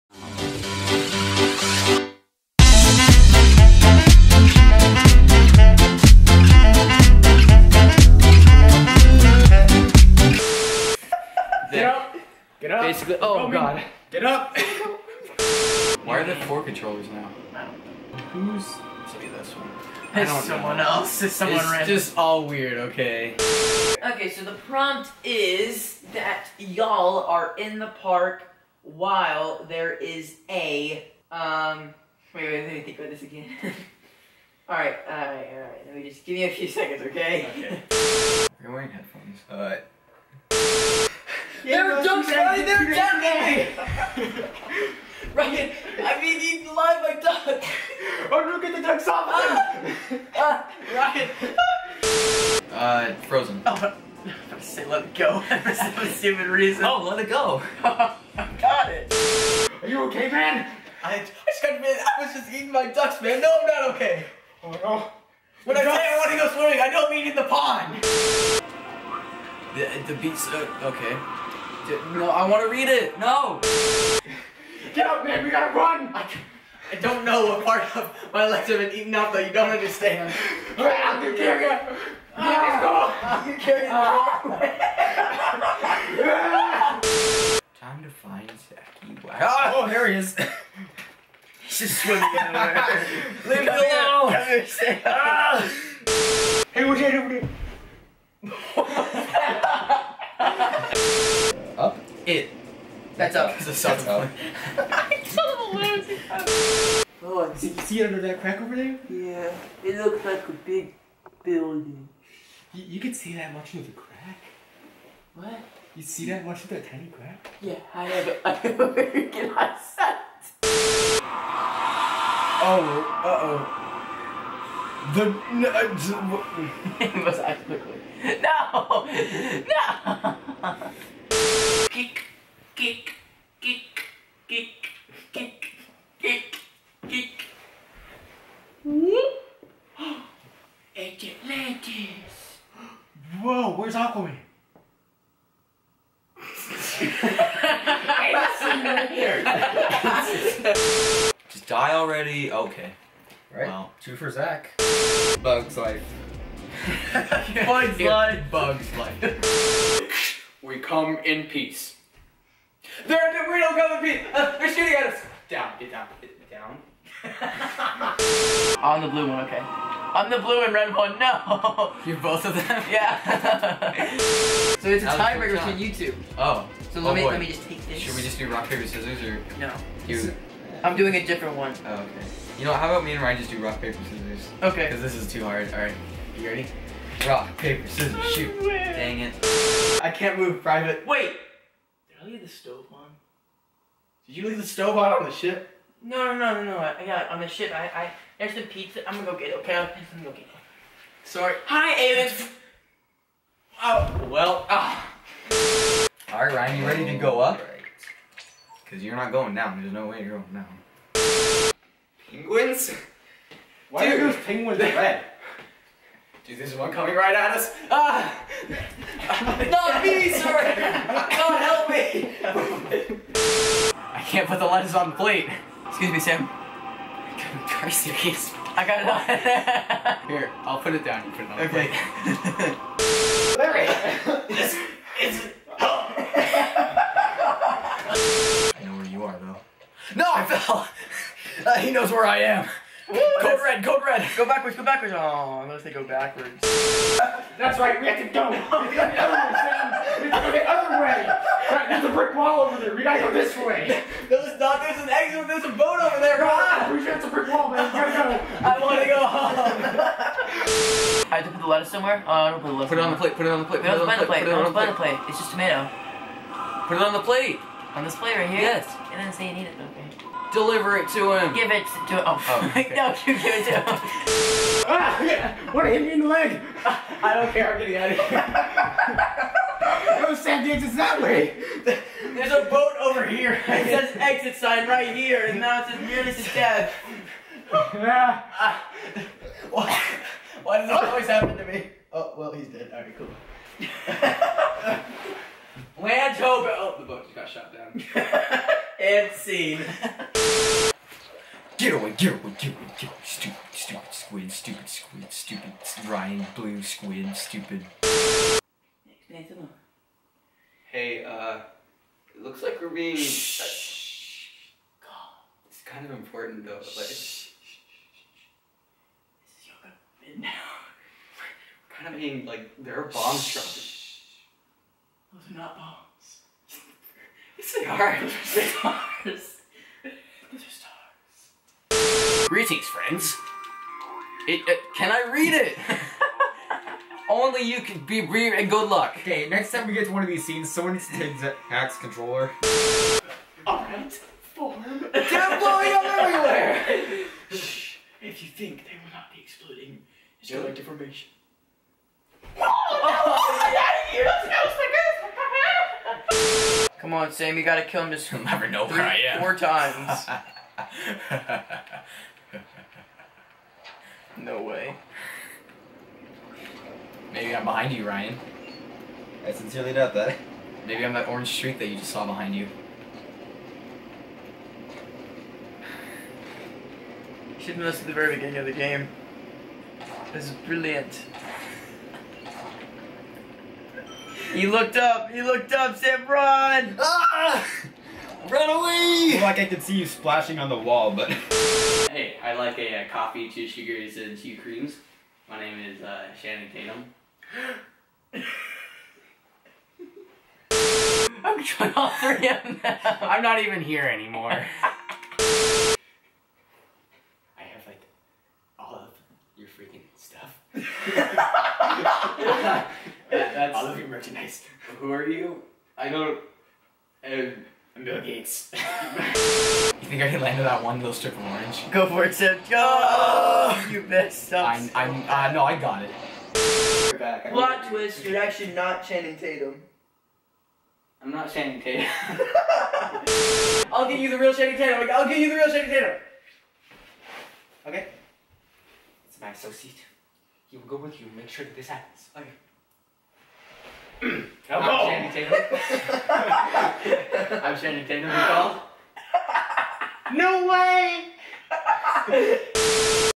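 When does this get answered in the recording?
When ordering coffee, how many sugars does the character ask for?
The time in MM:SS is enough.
06:33.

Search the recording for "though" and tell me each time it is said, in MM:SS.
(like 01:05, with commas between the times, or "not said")
03:59, 05:16.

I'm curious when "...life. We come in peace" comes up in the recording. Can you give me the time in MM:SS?
02:38.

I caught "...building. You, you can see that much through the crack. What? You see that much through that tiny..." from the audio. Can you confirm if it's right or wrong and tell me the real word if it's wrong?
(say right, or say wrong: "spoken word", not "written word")
right.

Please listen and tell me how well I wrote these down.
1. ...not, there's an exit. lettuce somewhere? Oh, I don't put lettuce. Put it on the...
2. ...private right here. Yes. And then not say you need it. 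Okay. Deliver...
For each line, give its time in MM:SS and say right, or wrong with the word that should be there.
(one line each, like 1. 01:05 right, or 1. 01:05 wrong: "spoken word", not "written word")
1. 04:14 right
2. 04:28 wrong: "plate", not "private".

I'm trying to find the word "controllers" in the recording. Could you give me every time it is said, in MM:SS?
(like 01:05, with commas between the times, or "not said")
00:16, 05:41.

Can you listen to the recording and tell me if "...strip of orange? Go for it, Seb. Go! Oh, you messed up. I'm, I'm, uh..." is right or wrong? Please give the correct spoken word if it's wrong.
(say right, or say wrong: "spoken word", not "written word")
right.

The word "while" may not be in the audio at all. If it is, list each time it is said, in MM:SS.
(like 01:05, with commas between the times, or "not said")
00:28.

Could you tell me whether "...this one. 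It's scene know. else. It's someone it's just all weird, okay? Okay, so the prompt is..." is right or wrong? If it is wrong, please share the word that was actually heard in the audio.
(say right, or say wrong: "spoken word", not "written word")
wrong: "someone", not "scene".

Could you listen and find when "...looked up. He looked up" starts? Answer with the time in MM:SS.
06:24.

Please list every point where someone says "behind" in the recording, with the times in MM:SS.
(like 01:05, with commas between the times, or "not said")
06:07, 06:12.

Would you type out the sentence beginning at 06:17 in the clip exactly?
Should've missed at the very beginning of the game.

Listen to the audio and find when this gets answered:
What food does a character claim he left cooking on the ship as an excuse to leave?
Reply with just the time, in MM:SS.
03:18.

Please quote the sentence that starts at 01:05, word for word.
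When I say I want to go swimming, I don't mean in the pond.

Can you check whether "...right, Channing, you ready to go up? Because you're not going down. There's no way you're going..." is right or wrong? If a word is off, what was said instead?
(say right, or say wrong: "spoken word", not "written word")
wrong: "Ryan", not "Channing".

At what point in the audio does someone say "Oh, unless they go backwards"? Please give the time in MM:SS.
04:05.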